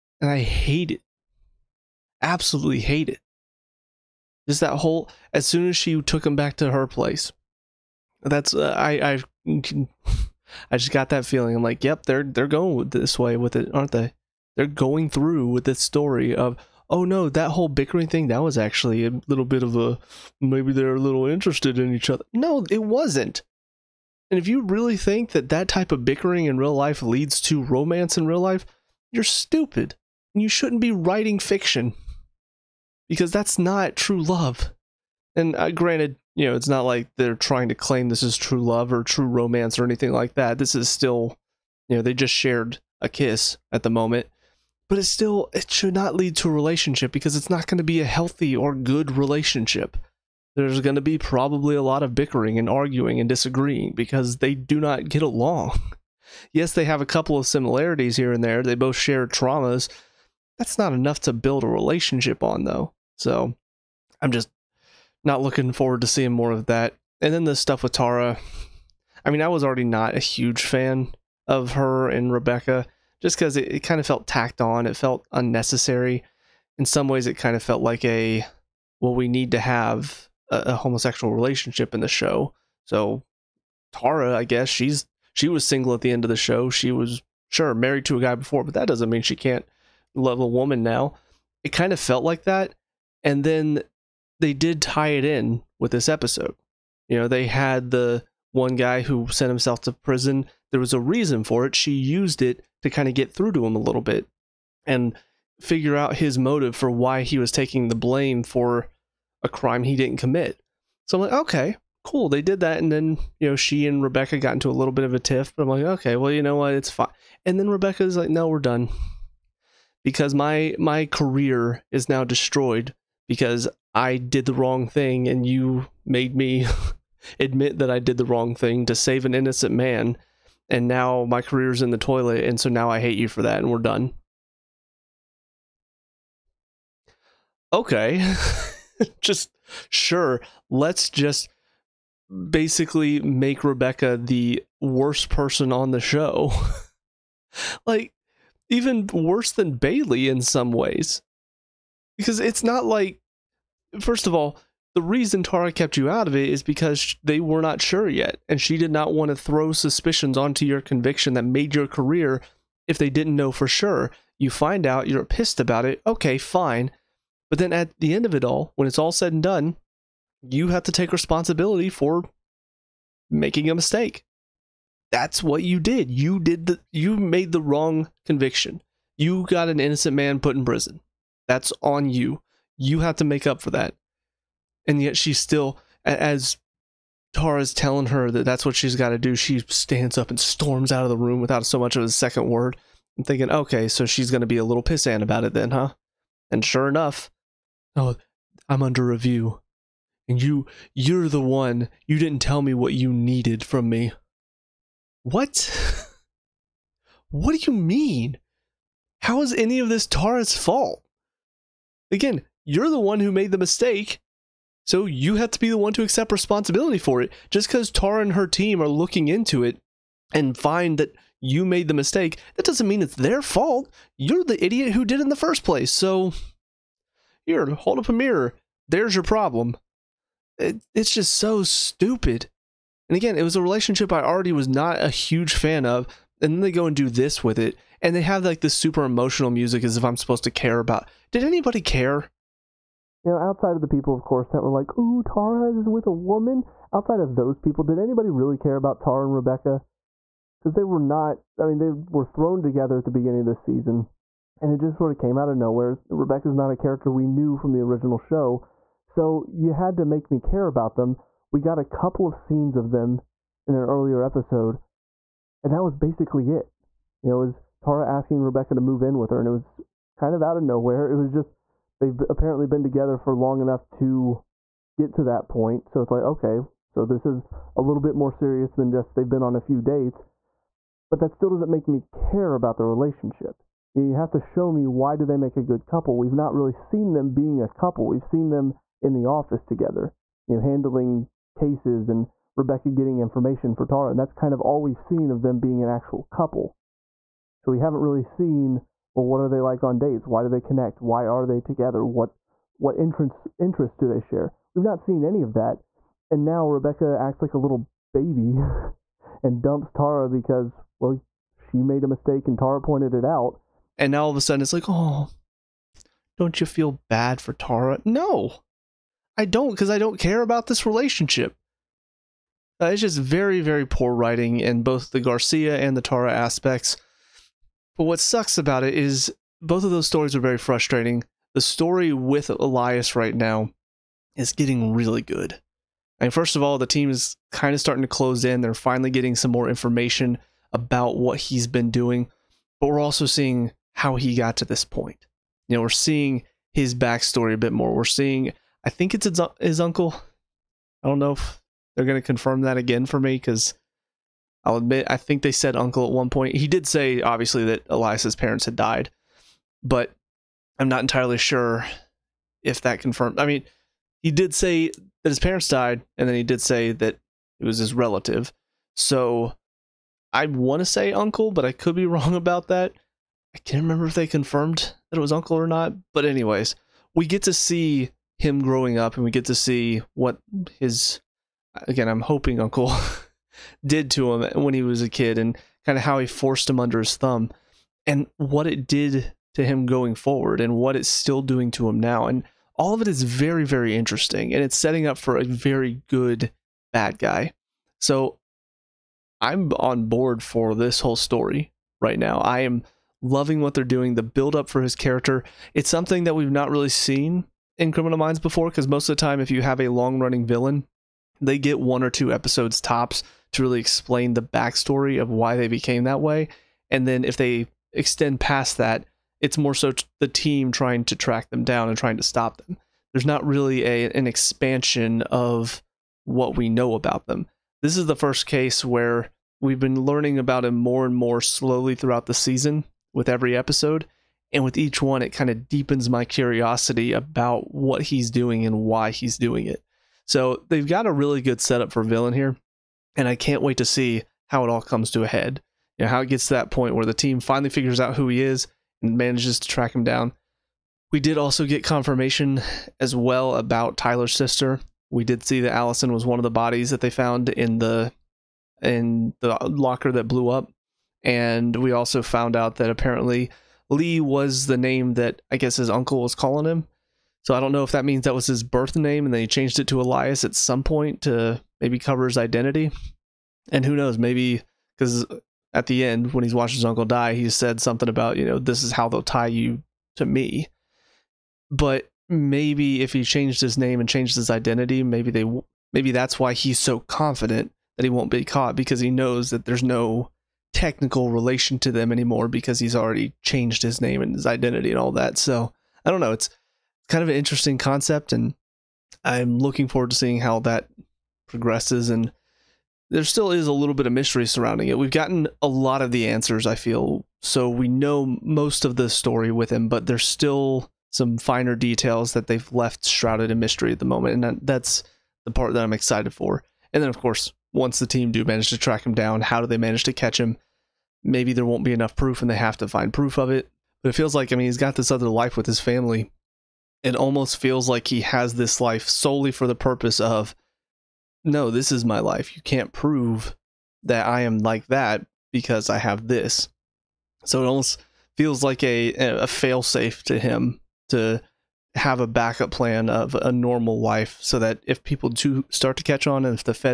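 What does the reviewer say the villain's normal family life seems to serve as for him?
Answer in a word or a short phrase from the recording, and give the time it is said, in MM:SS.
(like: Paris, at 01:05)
A fail safe, at 08:59.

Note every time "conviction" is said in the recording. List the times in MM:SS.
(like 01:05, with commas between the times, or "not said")
02:40, 02:58.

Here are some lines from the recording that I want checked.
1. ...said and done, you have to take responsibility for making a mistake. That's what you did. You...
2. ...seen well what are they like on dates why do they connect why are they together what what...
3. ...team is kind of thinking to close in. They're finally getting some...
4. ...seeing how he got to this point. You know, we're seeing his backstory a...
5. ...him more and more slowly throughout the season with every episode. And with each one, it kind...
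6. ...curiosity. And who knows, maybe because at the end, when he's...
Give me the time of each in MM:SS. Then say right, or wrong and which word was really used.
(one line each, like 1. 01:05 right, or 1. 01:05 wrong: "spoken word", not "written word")
1. 02:49 right
2. 04:58 right
3. 05:36 wrong: "starting", not "thinking"
4. 05:43 right
5. 07:10 right
6. 07:52 wrong: "identity", not "curiosity".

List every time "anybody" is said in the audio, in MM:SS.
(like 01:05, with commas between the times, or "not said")
04:01, 04:07.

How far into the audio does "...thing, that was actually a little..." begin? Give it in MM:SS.
00:18.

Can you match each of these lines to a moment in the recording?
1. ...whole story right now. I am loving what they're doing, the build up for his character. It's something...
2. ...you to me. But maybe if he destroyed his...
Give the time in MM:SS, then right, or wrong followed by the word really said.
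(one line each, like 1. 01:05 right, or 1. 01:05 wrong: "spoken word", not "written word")
1. 06:41 right
2. 07:59 wrong: "changed", not "destroyed".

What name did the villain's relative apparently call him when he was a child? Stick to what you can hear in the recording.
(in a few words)
Lee.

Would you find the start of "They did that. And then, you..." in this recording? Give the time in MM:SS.
01:52.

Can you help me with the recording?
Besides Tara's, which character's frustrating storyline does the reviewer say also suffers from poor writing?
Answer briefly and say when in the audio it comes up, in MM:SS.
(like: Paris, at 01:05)
Garcia, at 05:25.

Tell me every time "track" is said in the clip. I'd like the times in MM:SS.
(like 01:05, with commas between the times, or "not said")
07:01, 07:29, 08:38.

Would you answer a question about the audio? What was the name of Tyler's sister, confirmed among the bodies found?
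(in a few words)
Allison.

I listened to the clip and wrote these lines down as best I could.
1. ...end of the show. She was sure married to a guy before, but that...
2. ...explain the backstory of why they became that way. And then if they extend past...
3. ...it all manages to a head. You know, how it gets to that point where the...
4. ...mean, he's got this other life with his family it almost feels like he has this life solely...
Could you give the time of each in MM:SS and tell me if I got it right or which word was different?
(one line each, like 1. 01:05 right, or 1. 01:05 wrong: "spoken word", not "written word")
1. 01:26 right
2. 06:53 right
3. 07:24 wrong: "comes", not "manages"
4. 08:44 right.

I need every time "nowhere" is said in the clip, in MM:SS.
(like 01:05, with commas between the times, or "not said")
04:15, 04:30.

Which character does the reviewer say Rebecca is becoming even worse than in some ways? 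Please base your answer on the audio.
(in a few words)
Bailey.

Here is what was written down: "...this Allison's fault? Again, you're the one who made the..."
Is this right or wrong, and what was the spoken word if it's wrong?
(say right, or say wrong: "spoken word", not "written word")
wrong: "Tara", not "Allison".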